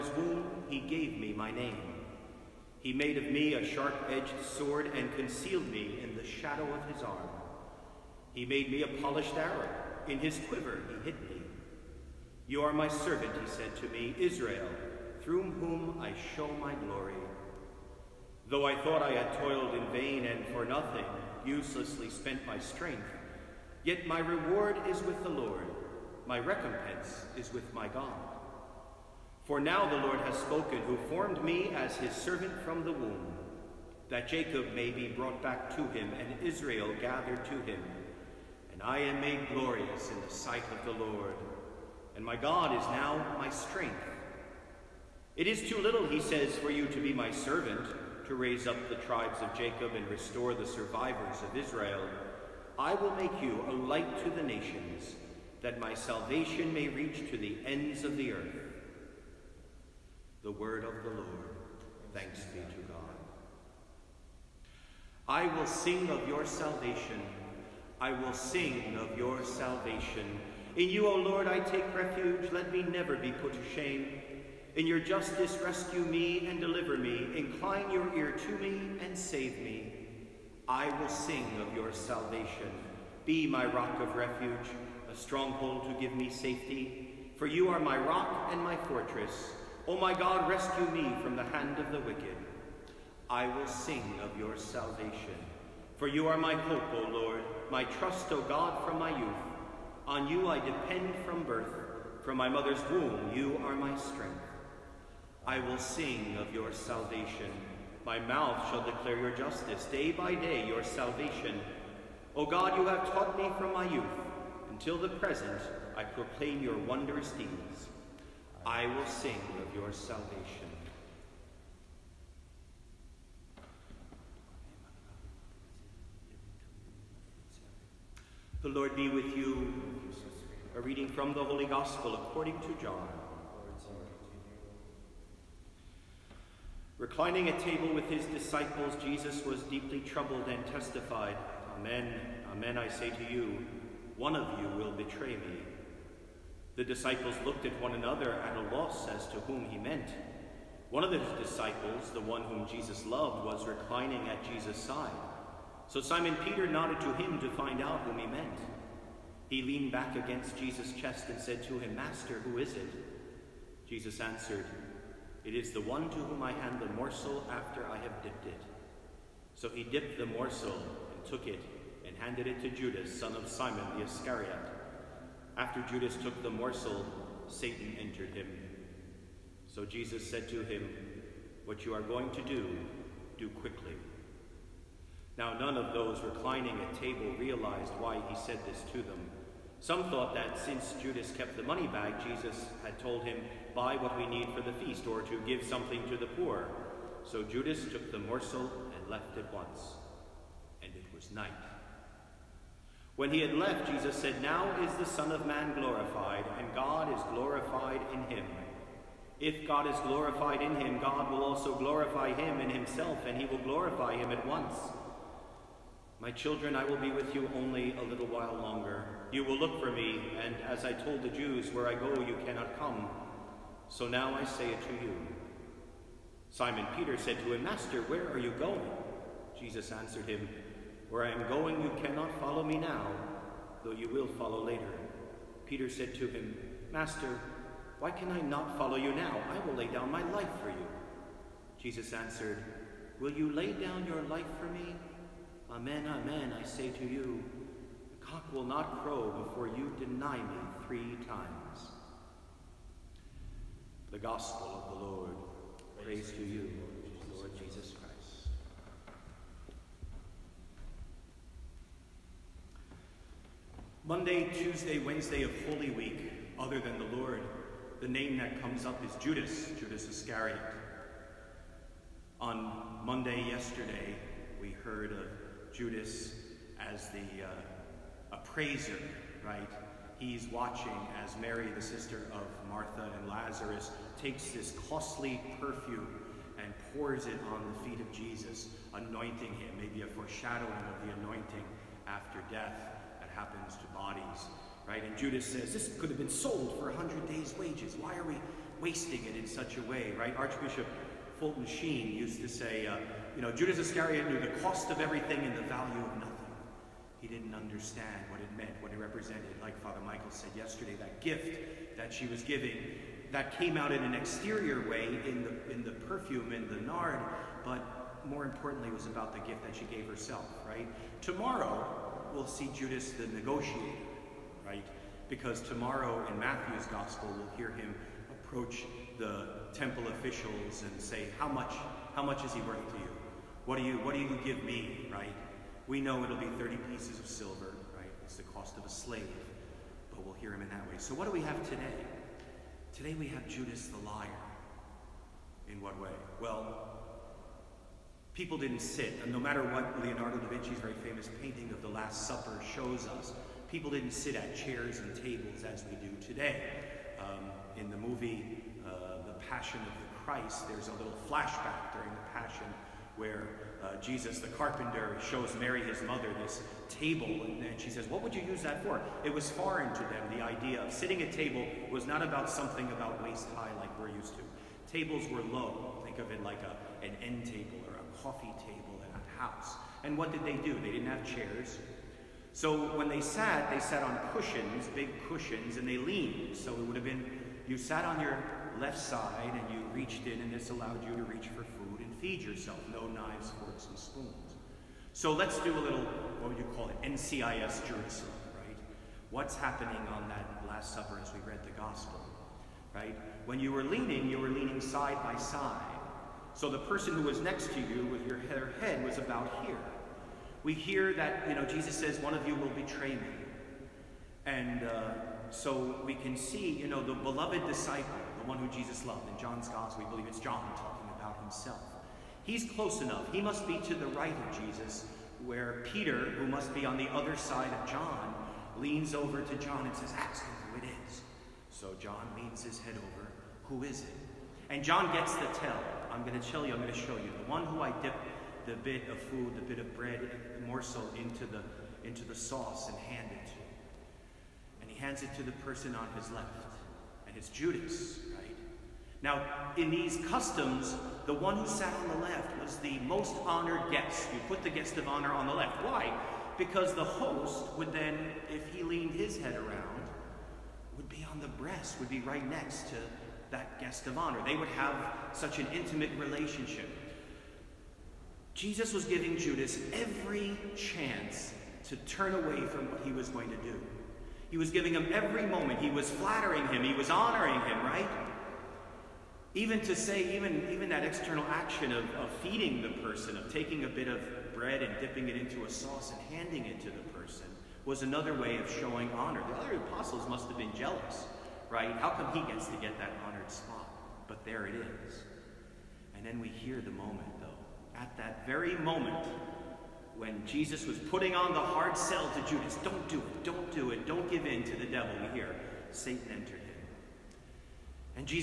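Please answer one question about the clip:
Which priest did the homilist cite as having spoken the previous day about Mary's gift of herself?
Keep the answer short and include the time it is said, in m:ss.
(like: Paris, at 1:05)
Father Michael, at 5:09.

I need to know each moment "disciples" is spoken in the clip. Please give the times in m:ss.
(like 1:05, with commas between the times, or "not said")
2:18, 2:26, 2:31, 6:57.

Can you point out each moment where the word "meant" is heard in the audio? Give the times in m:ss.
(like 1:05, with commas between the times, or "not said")
2:29, 2:38, 5:08.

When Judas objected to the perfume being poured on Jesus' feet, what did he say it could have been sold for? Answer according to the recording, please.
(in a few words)
100 days' wages.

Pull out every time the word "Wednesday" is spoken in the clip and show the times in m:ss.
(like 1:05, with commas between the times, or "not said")
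4:24.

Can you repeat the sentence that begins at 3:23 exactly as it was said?
When he had left, Jesus said, Now is the Son of Man glorified, and God is glorified in him.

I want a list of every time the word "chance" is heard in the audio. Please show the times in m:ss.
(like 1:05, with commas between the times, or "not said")
7:50.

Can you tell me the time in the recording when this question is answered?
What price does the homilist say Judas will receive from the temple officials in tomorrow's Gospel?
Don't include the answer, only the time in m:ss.
5:36.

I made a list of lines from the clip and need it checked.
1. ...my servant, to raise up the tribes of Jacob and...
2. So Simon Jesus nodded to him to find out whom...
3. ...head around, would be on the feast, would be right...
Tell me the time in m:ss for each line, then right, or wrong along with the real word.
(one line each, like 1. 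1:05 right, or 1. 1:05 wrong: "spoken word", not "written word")
1. 0:47 right
2. 2:35 wrong: "Peter", not "Jesus"
3. 7:39 wrong: "breast", not "feast".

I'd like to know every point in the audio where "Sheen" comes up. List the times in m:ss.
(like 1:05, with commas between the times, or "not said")
5:01.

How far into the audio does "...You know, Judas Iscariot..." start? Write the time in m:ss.
5:03.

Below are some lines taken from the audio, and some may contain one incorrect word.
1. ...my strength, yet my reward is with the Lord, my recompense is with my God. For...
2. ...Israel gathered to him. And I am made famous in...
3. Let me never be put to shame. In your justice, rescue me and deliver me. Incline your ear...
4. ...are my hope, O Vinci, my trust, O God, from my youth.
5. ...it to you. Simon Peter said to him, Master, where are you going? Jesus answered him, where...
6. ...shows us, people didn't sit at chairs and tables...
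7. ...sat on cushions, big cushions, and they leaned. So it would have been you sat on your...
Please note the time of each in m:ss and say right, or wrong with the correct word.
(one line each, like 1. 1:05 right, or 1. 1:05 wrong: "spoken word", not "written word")
1. 0:22 right
2. 0:36 wrong: "glorious", not "famous"
3. 1:12 right
4. 1:36 wrong: "Lord", not "Vinci"
5. 3:44 right
6. 5:52 right
7. 6:23 right.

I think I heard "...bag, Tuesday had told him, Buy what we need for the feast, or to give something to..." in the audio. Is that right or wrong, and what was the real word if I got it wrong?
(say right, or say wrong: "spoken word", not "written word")
wrong: "Jesus", not "Tuesday".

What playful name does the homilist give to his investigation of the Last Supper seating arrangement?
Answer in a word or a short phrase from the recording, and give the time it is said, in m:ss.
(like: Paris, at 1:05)
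NCIS Jerusalem, at 6:37.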